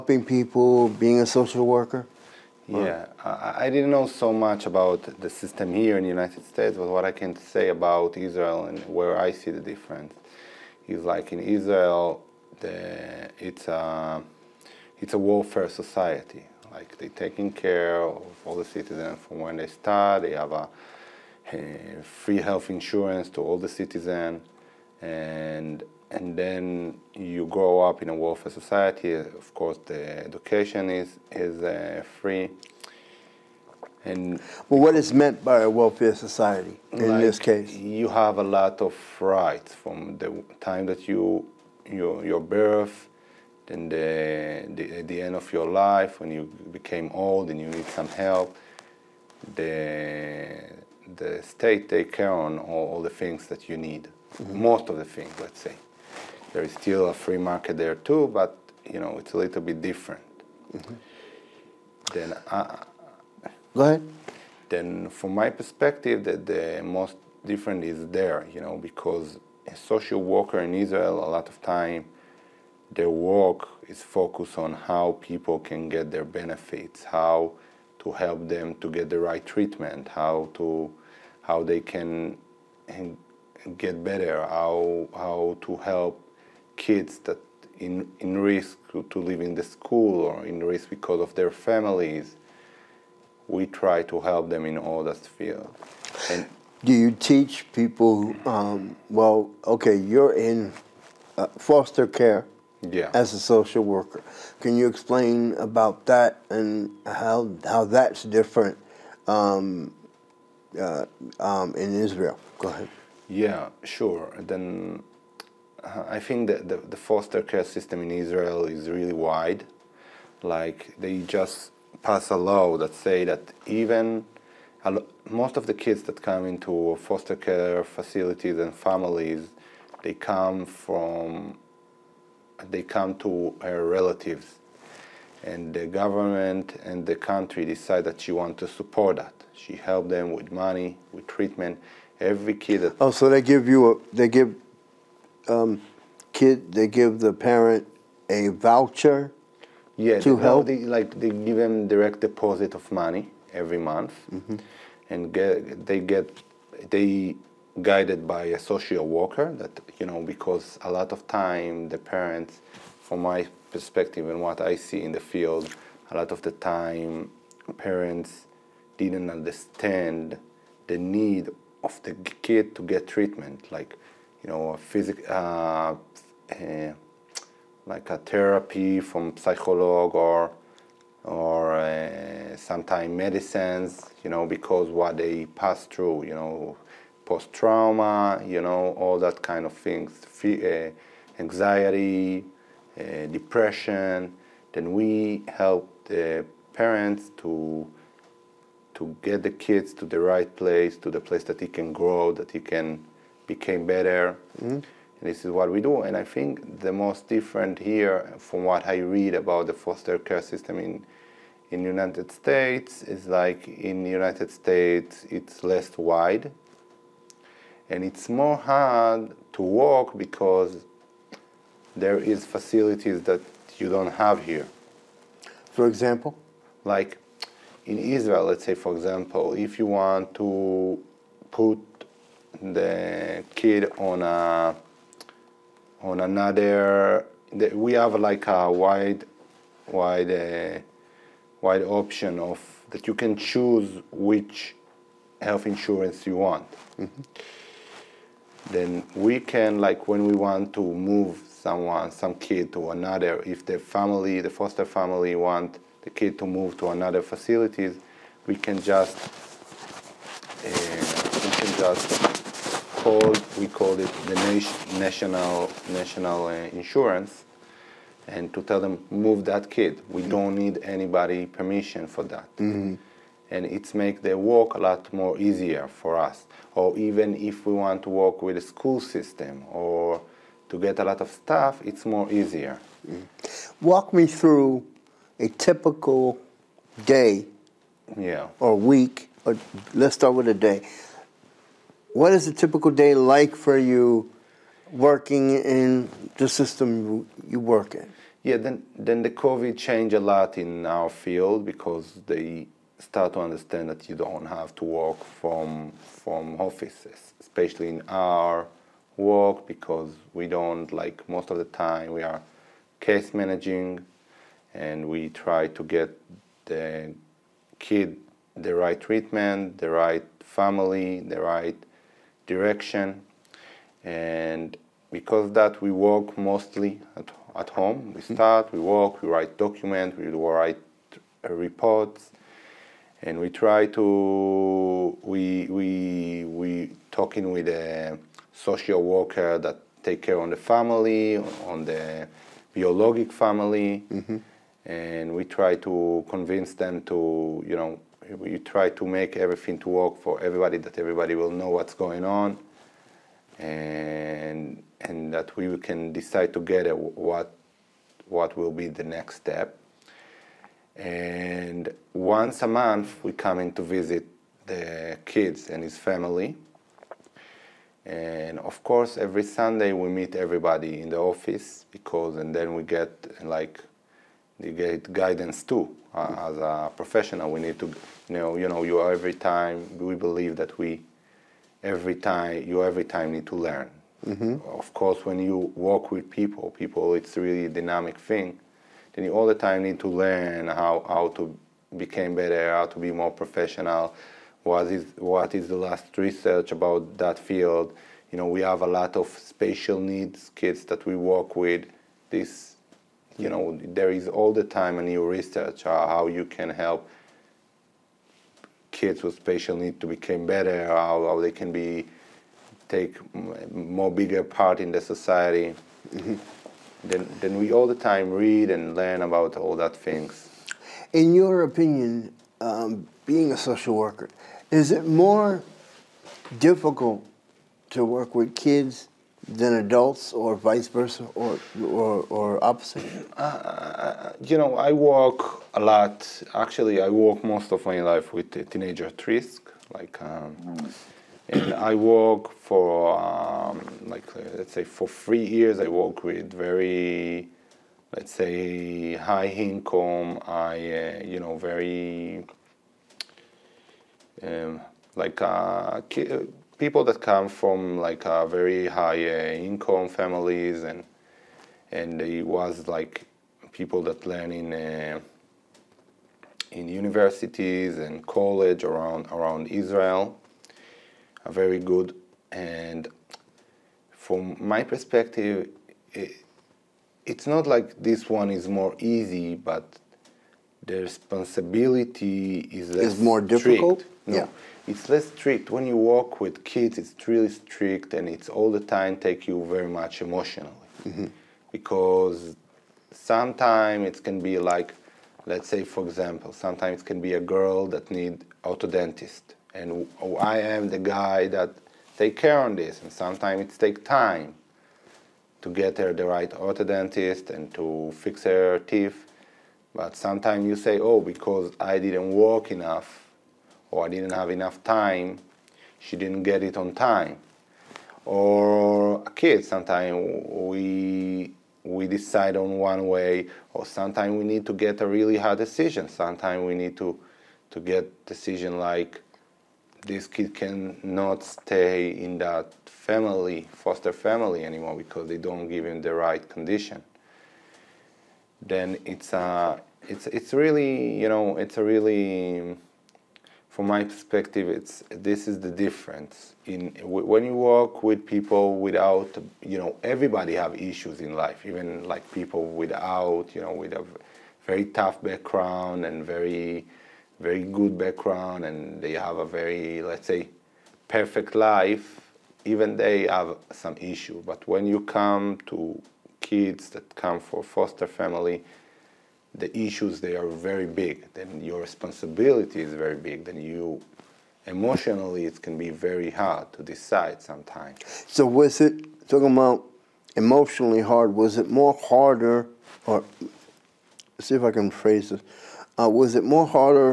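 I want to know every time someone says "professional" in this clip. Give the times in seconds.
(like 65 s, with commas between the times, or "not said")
376 s, 393 s.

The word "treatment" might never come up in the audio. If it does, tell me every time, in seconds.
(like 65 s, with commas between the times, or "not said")
79 s, 141 s, 173 s, 318 s.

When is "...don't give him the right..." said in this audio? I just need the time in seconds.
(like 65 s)
535 s.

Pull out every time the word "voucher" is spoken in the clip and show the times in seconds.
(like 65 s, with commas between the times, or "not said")
148 s.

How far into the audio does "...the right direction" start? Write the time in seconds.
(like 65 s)
321 s.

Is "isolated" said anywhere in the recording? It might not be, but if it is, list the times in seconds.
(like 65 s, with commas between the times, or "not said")
not said.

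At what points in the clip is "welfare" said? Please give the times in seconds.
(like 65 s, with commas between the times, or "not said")
15 s, 28 s, 35 s.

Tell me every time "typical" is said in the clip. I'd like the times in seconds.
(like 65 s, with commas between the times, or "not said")
285 s, 292 s.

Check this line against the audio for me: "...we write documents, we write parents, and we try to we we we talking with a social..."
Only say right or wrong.
wrong.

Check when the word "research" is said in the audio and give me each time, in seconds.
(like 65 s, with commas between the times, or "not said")
396 s, 405 s.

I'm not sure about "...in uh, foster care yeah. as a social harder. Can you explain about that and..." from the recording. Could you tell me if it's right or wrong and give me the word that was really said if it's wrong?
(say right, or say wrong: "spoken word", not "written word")
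wrong: "worker", not "harder".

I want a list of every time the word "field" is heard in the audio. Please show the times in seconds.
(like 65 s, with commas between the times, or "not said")
95 s, 165 s, 301 s, 397 s.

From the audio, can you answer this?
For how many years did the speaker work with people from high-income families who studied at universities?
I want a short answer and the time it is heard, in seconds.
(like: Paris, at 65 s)
3, at 445 s.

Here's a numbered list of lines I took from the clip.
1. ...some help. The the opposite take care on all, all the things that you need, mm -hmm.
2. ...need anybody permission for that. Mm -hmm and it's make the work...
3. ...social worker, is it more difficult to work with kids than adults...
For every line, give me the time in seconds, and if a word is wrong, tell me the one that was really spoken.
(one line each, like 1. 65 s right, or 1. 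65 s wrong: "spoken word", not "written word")
1. 47 s wrong: "state", not "opposite"
2. 270 s right
3. 423 s right.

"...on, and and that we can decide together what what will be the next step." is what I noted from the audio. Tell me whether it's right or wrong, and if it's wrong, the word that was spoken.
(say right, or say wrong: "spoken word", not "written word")
right.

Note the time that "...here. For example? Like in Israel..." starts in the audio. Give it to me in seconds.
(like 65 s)
224 s.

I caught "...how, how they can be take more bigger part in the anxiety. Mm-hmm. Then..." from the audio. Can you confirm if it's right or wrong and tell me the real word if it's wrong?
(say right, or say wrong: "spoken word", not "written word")
wrong: "society", not "anxiety".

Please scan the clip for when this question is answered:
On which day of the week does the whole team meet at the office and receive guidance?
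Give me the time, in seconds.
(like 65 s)
369 s.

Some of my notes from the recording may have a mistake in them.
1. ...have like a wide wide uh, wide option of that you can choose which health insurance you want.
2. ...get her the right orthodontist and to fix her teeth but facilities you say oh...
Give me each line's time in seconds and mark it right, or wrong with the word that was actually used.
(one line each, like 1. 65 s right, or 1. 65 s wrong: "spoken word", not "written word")
1. 237 s right
2. 505 s wrong: "sometimes", not "facilities".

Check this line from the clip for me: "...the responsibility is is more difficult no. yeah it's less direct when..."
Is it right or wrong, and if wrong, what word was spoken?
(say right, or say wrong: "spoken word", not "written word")
wrong: "strict", not "direct".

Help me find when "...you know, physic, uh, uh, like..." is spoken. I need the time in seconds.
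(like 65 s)
174 s.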